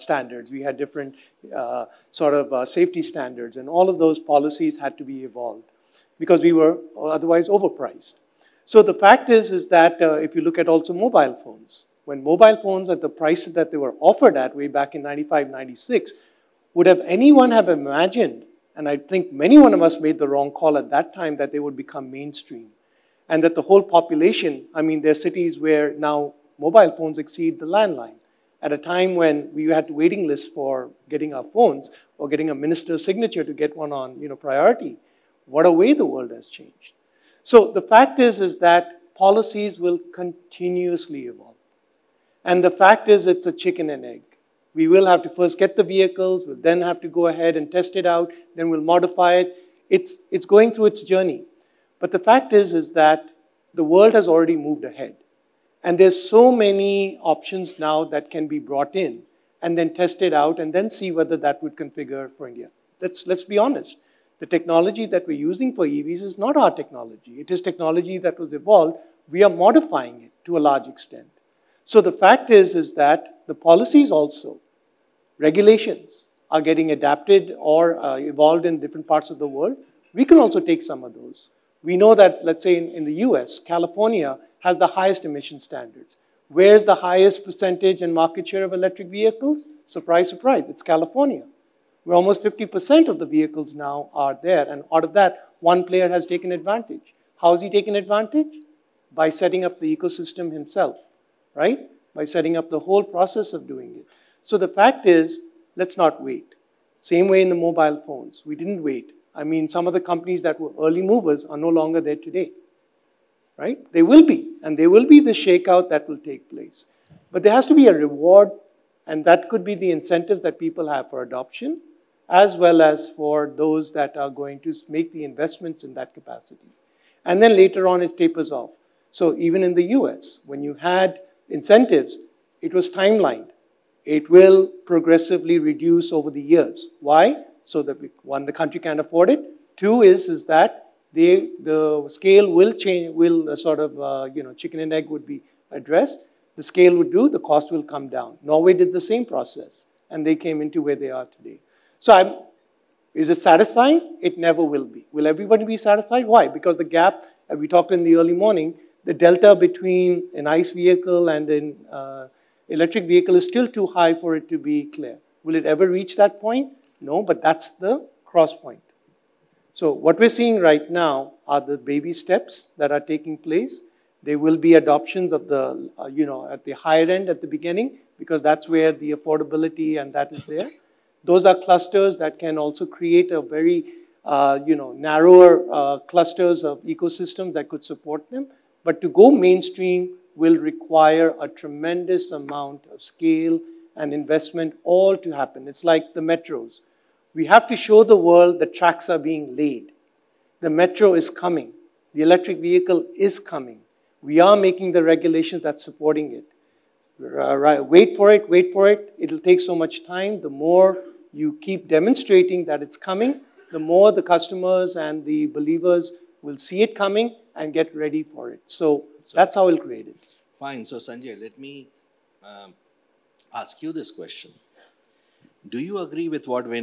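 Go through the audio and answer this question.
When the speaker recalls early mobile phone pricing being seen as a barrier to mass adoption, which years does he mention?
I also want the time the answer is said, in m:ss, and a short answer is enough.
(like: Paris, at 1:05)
95, 96, at 0:15.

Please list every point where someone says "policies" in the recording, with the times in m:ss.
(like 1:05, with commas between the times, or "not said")
0:04, 0:39, 1:13.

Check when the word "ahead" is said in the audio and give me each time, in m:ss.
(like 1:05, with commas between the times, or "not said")
0:47, 0:54.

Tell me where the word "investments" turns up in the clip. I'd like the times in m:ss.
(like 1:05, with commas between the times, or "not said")
2:05, 3:14.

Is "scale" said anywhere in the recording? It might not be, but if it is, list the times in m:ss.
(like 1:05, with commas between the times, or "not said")
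2:22, 2:26, 3:13.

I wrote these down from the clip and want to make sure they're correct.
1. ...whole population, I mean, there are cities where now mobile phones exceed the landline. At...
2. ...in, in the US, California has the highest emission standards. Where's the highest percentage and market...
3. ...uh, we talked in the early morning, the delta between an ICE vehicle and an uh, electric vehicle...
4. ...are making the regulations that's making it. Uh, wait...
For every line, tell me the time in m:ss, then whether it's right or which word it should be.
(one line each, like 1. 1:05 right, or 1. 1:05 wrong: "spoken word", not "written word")
1. 0:23 right
2. 1:22 right
3. 2:37 right
4. 3:24 wrong: "supporting", not "making".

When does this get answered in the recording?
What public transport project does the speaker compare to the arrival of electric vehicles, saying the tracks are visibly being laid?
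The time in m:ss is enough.
3:16.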